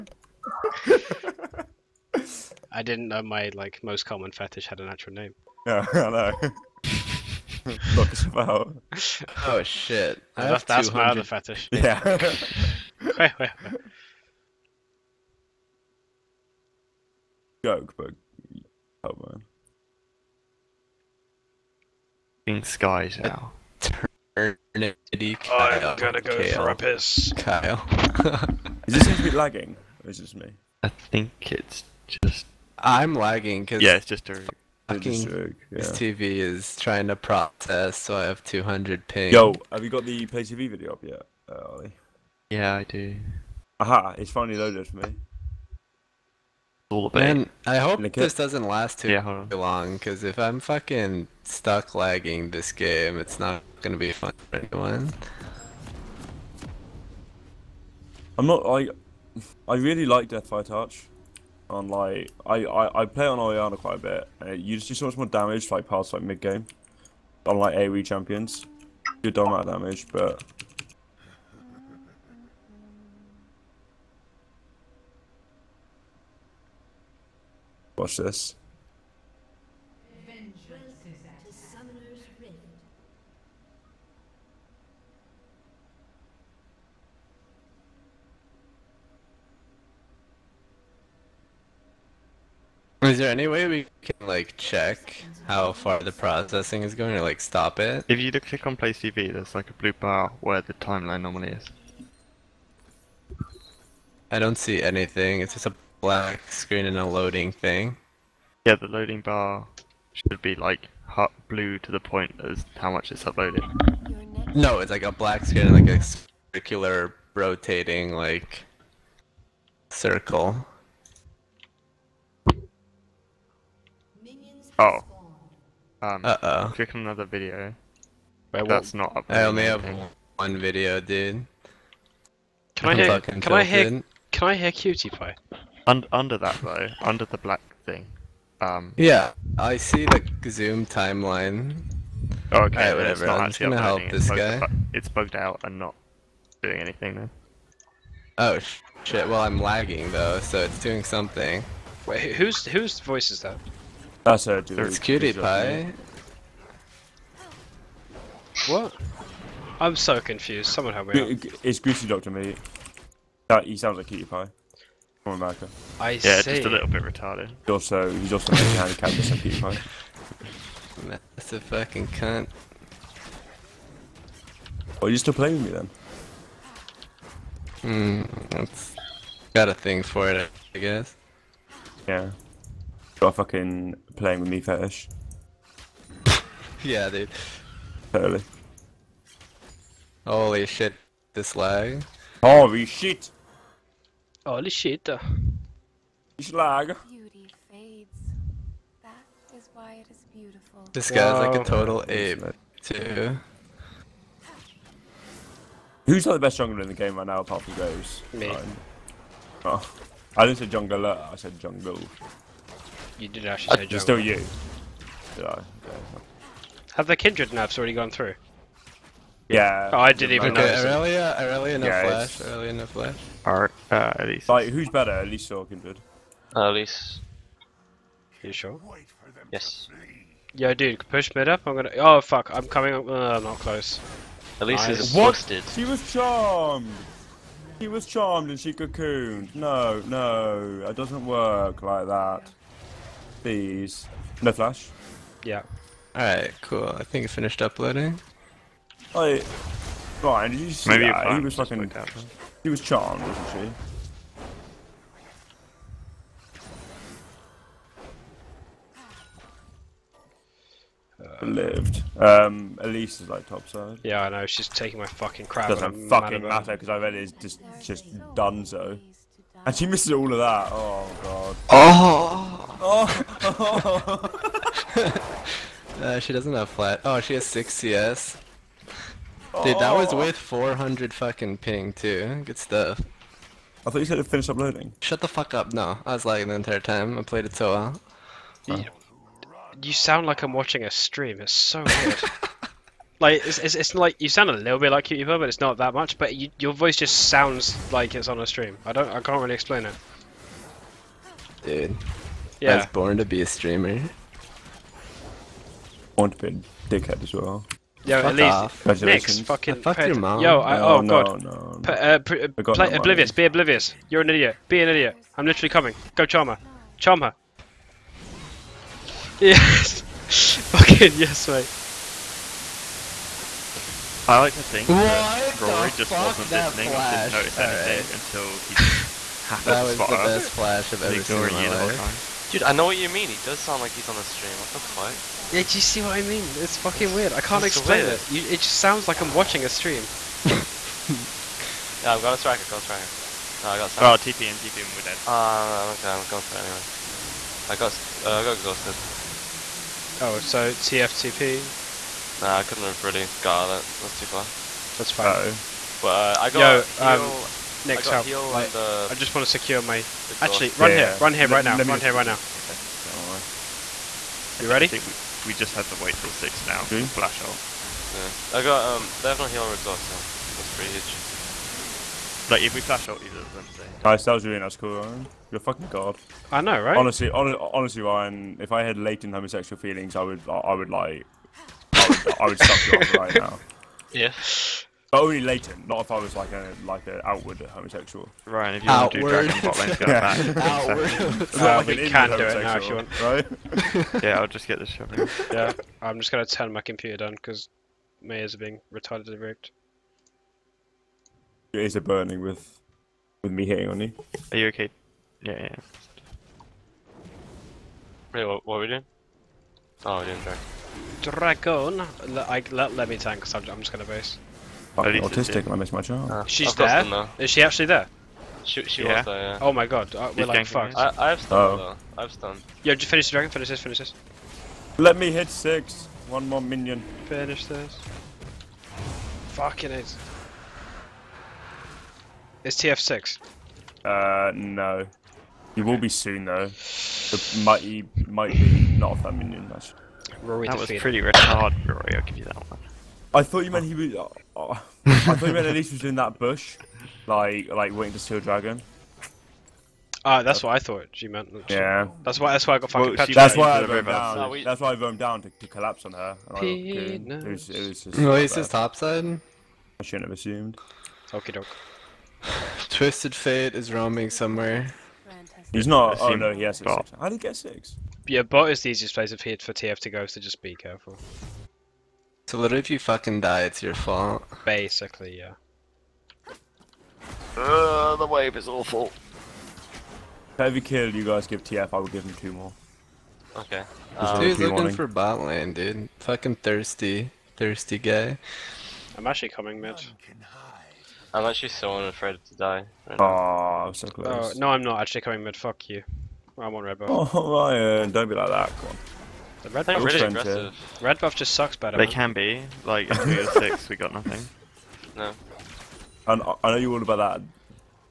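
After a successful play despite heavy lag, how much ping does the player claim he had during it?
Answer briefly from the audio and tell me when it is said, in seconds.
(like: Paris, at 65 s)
400, at 280 s.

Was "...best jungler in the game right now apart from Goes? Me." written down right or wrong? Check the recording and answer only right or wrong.
right.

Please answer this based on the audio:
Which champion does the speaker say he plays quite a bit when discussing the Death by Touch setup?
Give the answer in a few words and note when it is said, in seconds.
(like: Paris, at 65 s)
Orianna, at 63 s.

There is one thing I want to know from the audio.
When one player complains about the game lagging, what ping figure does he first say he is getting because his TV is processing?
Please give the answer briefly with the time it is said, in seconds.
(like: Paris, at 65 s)
200, at 38 s.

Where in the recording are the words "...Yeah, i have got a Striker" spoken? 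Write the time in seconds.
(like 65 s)
341 s.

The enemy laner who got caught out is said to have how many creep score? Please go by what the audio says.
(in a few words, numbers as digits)
6.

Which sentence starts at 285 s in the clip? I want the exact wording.
No, I was lagging the entire time.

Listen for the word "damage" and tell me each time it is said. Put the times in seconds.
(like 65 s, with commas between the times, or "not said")
65 s, 69 s.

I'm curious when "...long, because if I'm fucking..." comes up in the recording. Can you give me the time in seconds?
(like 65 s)
49 s.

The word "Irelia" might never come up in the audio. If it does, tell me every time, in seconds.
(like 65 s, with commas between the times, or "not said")
221 s.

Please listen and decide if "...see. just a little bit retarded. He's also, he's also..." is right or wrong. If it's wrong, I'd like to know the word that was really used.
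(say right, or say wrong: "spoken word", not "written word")
right.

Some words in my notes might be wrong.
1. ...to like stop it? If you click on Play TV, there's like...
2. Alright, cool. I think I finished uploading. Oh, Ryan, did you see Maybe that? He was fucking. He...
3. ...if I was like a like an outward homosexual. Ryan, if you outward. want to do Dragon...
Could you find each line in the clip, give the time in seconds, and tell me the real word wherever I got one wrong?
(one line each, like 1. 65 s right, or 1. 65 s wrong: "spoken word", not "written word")
1. 97 s right
2. 246 s right
3. 385 s right.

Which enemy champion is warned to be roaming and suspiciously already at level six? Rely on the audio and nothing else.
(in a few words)
Twisted Fate.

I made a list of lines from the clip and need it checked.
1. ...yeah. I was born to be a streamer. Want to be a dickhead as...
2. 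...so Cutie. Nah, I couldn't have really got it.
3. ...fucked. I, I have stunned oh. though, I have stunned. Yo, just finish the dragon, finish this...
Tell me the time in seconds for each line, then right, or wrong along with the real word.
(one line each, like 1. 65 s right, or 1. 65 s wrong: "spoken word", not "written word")
1. 302 s right
2. 350 s wrong: "TFTP", not "Cutie"
3. 420 s right.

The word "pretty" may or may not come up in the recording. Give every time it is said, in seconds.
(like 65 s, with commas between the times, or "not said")
370 s, 440 s.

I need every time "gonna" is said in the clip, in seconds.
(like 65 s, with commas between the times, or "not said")
53 s, 143 s, 231 s, 396 s.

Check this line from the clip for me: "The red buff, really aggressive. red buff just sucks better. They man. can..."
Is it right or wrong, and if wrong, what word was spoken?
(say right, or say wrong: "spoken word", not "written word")
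right.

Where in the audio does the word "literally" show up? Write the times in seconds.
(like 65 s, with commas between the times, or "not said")
315 s, 472 s.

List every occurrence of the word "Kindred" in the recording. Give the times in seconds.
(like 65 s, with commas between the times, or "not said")
217 s, 225 s.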